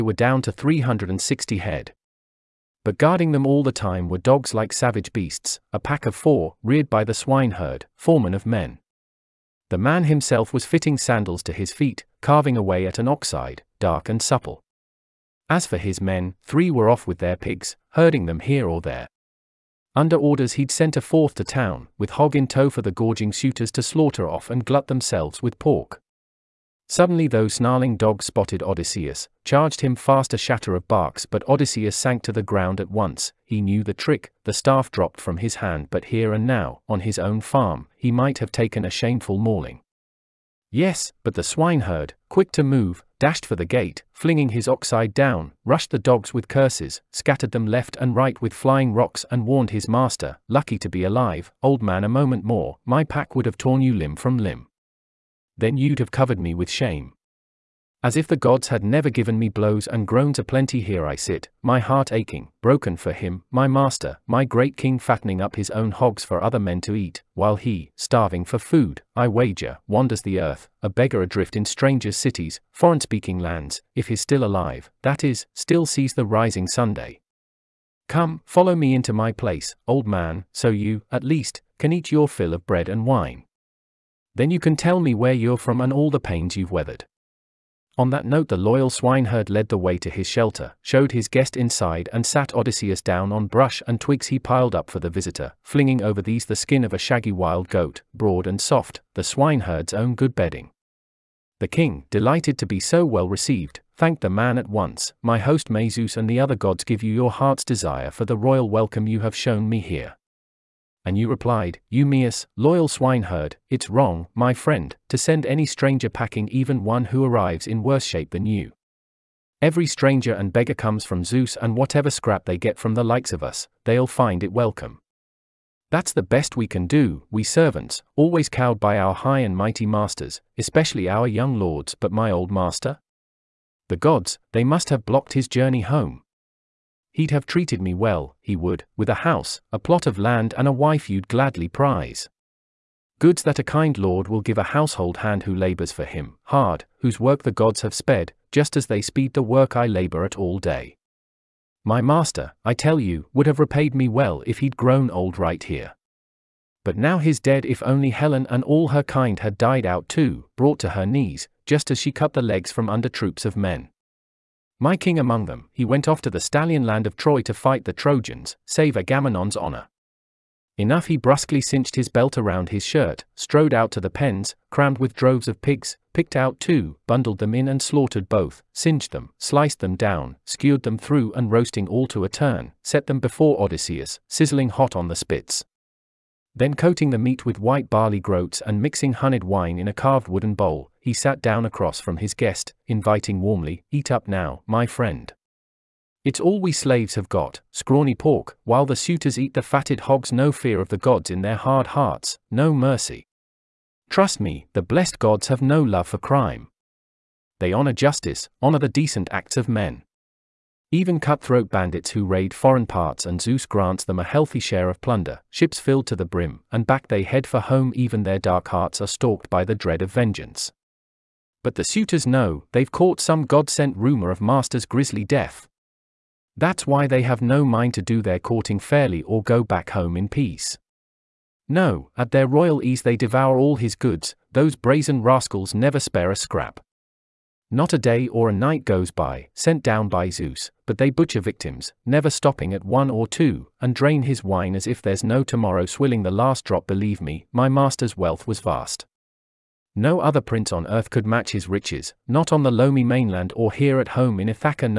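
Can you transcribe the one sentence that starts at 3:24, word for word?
Trust me, the blessed gods have no love for crime.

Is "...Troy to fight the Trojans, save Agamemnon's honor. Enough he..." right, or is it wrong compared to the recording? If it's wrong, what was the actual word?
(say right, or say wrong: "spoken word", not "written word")
right.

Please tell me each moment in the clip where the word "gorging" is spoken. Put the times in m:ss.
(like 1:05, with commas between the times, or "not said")
0:22.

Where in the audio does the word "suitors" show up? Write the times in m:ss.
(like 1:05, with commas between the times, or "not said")
0:23, 3:18, 3:41.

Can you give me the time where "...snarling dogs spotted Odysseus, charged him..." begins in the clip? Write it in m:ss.
0:27.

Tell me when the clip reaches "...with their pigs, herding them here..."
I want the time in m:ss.
0:17.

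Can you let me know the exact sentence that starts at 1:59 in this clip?
Every stranger and beggar comes from Zeus, and whatever scrap they get from the likes of us, they'll find it welcome.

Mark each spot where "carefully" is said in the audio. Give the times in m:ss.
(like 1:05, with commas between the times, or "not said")
not said.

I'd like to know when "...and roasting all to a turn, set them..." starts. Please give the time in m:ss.
3:01.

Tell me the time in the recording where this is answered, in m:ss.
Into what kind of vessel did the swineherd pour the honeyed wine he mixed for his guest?
3:09.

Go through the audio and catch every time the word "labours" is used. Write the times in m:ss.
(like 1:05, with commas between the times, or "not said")
2:25, 2:29.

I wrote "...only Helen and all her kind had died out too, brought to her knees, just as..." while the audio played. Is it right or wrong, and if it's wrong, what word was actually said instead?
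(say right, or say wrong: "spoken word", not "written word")
right.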